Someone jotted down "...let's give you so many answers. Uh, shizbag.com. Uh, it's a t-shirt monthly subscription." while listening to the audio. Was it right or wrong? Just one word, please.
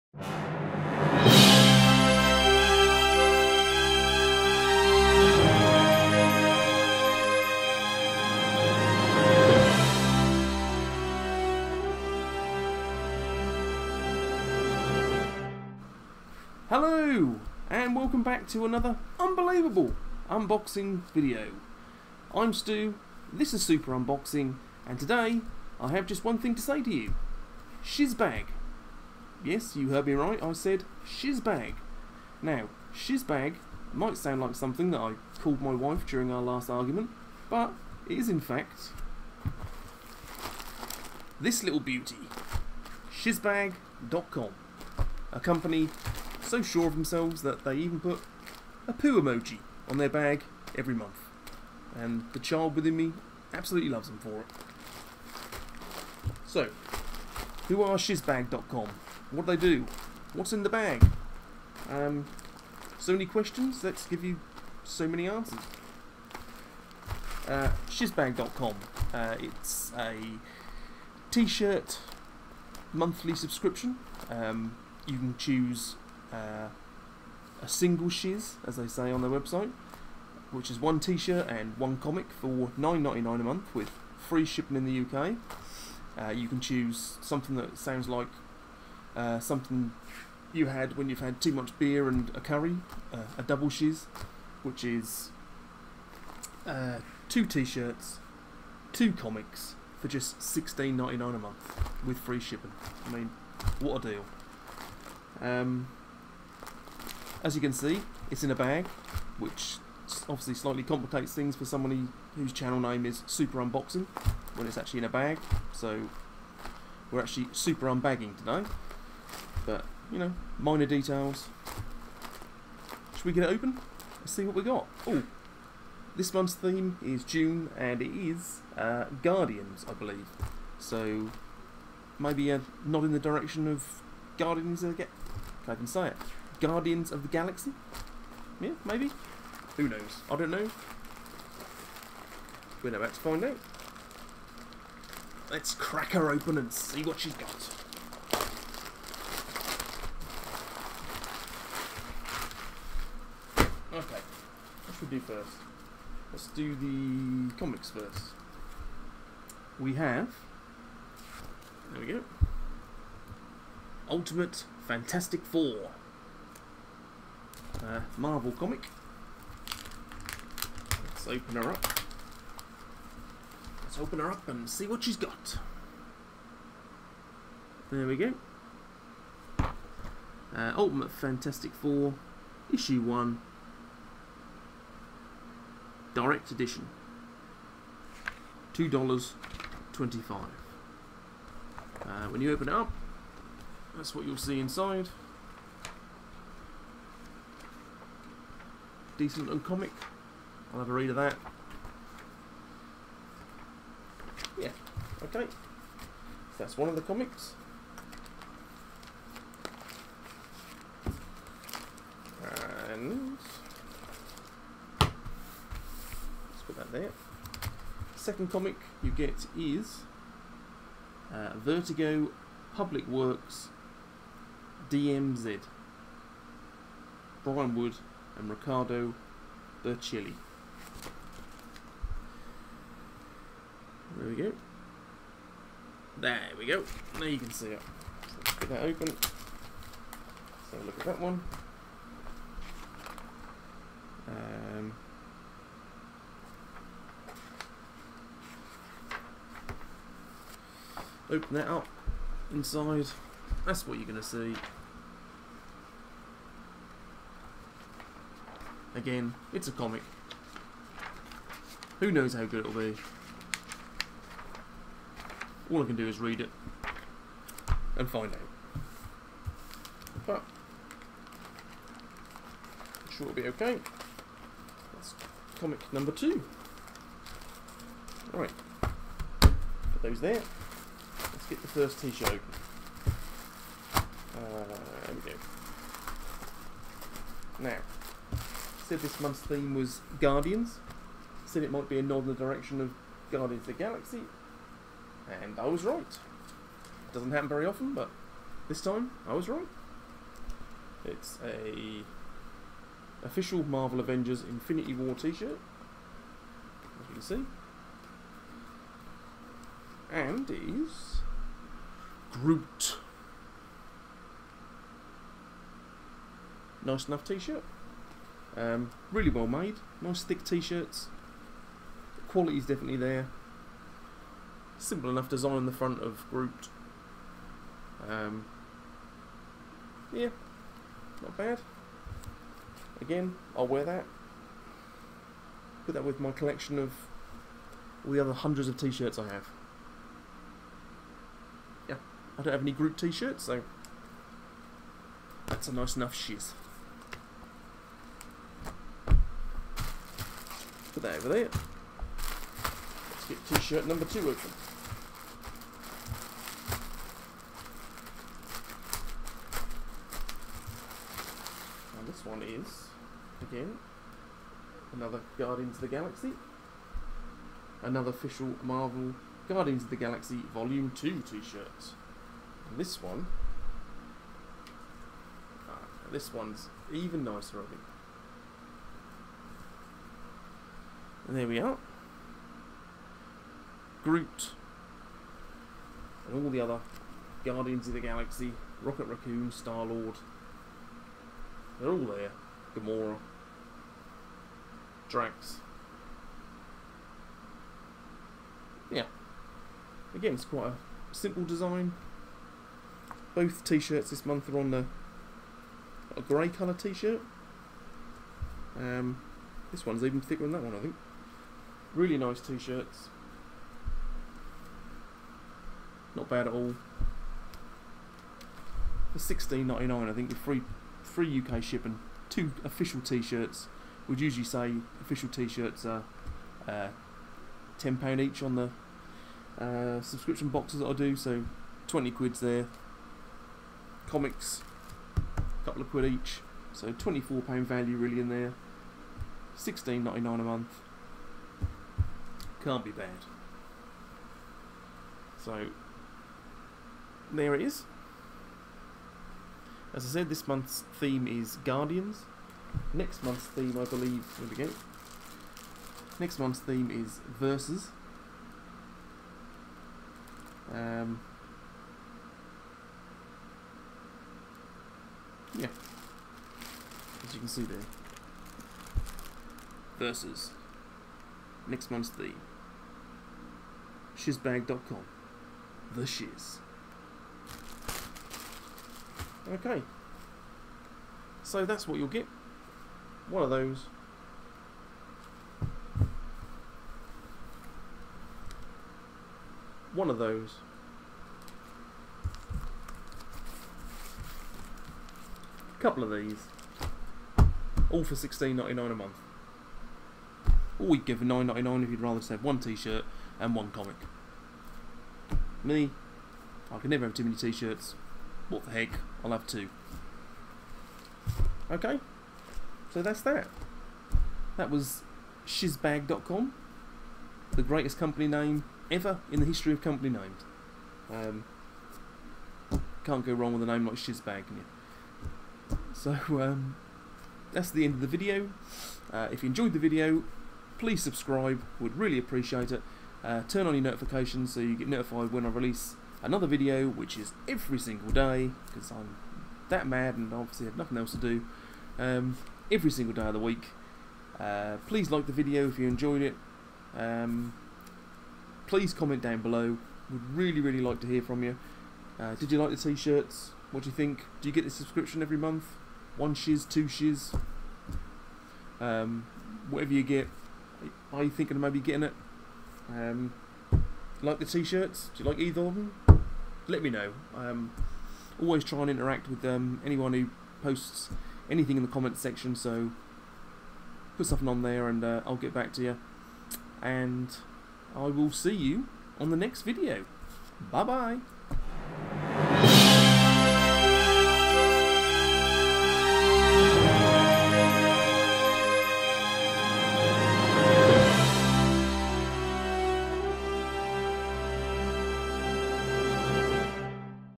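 right.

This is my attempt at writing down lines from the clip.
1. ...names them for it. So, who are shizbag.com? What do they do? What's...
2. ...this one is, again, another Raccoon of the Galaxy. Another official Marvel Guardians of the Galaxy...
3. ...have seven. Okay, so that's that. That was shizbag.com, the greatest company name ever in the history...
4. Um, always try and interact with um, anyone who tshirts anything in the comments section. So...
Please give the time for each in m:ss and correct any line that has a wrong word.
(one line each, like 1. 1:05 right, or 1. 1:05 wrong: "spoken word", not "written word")
1. 0:53 wrong: "loves", not "names"
2. 6:02 wrong: "Guardians", not "Raccoon"
3. 8:29 wrong: "two", not "seven"
4. 9:27 wrong: "posts", not "tshirts".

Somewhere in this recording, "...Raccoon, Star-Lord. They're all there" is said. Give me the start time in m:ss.
6:29.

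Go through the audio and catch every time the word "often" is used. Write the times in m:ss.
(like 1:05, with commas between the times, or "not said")
4:57.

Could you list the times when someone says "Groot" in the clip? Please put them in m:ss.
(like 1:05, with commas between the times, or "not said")
5:12, 5:26, 5:42, 6:24.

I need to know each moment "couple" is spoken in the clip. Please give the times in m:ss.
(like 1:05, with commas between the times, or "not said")
7:15, 8:15.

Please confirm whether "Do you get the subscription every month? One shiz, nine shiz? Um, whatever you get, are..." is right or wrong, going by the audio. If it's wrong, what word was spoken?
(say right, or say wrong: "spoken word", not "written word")
wrong: "two", not "nine".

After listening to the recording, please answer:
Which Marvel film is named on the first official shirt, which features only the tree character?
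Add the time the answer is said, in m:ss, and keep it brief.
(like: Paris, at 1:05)
Avengers Infinity War, at 5:04.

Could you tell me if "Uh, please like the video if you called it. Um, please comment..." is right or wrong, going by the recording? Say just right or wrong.
wrong.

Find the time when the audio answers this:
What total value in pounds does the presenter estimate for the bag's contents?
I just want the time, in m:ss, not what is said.
7:16.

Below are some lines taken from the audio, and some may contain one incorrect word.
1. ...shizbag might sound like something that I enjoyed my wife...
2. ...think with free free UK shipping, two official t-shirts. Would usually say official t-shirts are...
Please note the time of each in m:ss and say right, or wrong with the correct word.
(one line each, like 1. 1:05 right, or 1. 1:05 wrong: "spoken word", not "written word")
1. 0:32 wrong: "called", not "enjoyed"
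2. 7:00 right.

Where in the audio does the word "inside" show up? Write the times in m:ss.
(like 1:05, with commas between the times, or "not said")
3:14, 4:12.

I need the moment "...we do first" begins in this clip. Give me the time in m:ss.
2:35.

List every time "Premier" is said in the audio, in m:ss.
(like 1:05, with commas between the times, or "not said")
not said.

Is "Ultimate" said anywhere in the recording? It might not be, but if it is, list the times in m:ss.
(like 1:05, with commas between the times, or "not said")
2:44, 3:00.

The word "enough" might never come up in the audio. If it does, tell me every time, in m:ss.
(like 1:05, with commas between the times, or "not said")
5:17, 5:25, 5:45.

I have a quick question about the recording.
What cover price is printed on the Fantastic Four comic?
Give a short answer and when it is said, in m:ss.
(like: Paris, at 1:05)
$2.25, at 3:08.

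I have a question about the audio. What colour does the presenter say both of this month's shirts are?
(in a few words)
Grey.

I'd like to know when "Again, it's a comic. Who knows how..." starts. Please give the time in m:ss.
4:18.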